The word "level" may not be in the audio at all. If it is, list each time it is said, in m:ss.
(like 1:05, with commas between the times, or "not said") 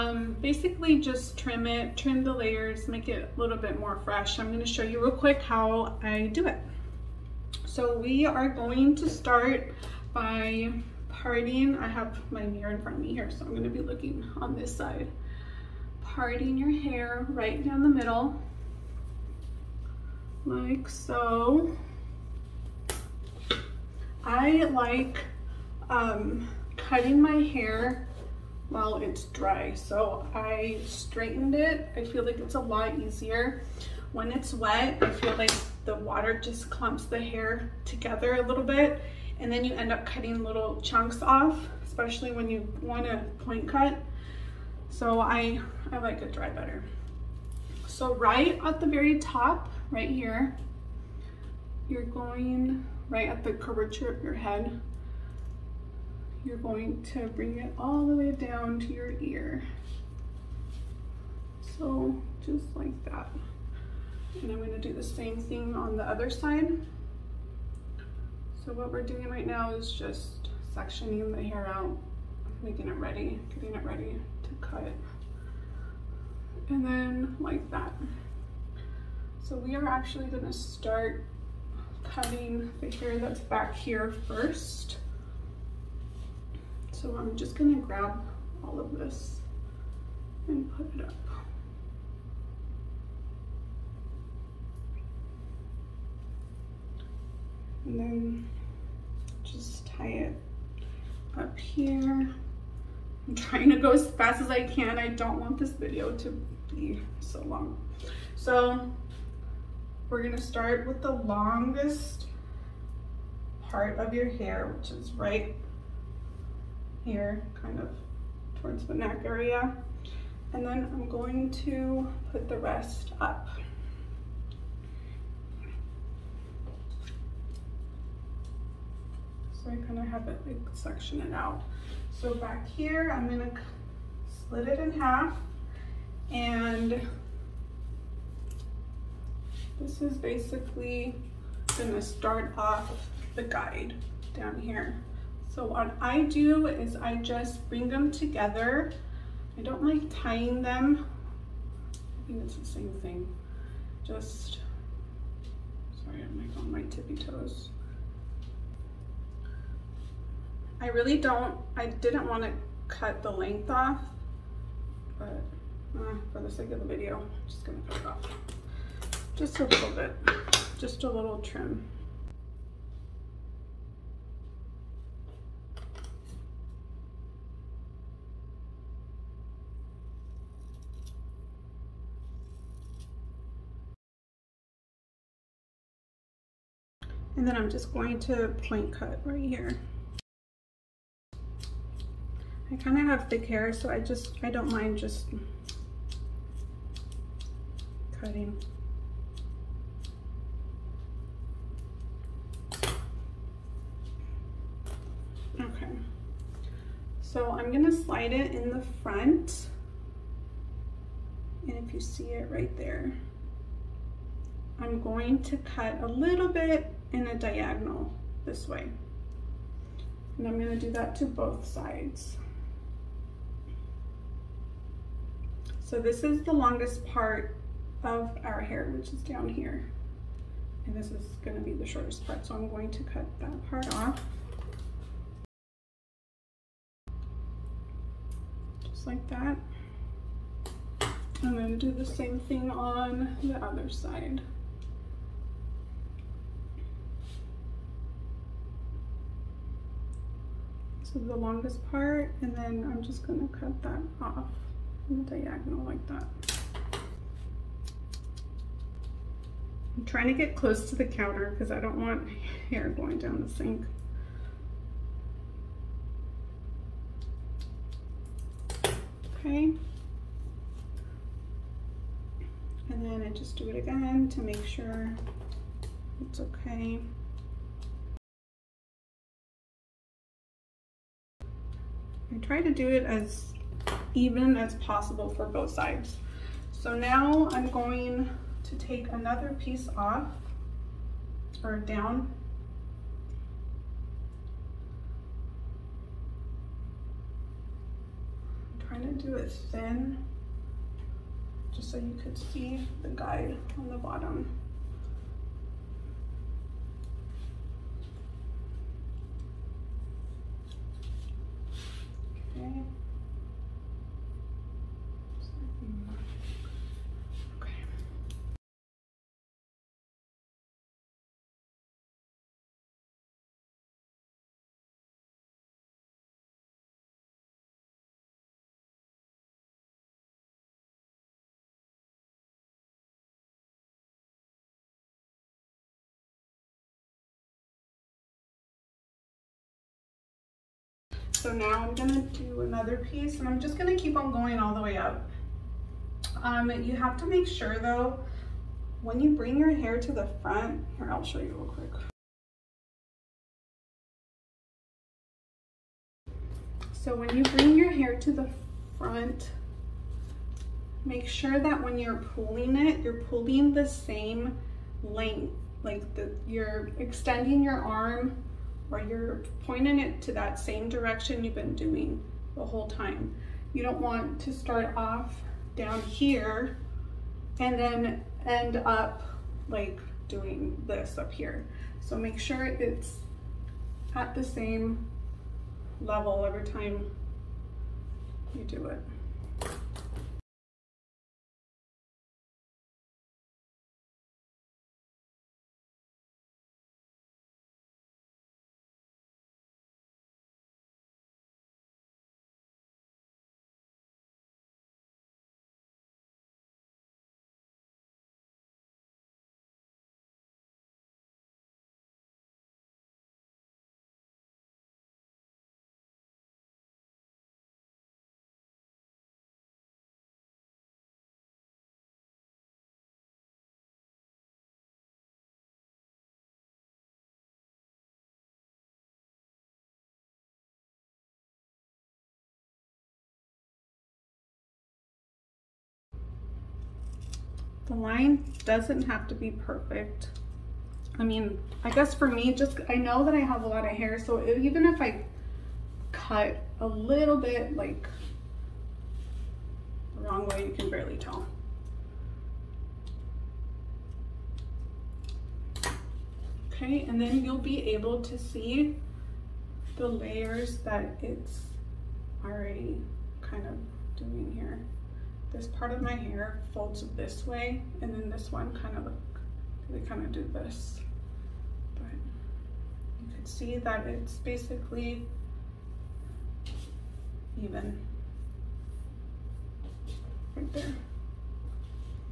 6:26.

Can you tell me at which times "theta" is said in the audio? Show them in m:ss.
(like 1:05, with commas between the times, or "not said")
not said.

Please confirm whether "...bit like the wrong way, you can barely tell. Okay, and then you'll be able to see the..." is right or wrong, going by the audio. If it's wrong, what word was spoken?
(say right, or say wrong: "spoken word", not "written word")
right.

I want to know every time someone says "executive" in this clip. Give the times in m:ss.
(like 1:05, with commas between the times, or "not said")
not said.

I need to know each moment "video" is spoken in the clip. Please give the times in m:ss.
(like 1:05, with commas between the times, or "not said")
1:45, 2:46.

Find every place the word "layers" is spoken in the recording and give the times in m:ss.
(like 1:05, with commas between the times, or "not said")
0:02, 7:40.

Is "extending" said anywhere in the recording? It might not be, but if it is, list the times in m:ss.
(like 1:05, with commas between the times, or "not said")
6:06.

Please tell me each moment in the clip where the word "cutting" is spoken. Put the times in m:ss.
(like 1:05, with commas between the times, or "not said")
0:26, 0:40, 1:22, 3:18.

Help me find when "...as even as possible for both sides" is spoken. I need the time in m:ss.
4:43.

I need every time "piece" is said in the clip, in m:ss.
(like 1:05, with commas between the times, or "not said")
4:49, 5:43.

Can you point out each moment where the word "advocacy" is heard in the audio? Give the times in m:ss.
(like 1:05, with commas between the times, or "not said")
not said.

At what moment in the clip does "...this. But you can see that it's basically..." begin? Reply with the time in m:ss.
7:50.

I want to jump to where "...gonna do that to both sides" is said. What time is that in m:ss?
3:40.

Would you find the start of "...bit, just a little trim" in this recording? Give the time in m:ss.
2:49.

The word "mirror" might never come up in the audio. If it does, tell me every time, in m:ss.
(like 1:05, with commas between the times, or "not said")
0:12.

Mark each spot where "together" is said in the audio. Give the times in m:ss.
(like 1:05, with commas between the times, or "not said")
0:37, 2:28.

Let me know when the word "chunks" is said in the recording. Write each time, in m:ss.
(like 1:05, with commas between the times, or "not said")
0:40.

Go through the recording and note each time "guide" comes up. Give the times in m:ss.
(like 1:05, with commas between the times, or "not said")
2:23, 5:03.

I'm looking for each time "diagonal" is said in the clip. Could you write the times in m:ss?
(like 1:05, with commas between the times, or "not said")
3:37, 4:15.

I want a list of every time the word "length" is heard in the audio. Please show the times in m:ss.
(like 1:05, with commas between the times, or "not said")
2:43, 6:05.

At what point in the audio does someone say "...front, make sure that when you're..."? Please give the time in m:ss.
5:58.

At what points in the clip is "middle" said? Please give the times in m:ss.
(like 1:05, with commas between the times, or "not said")
0:17.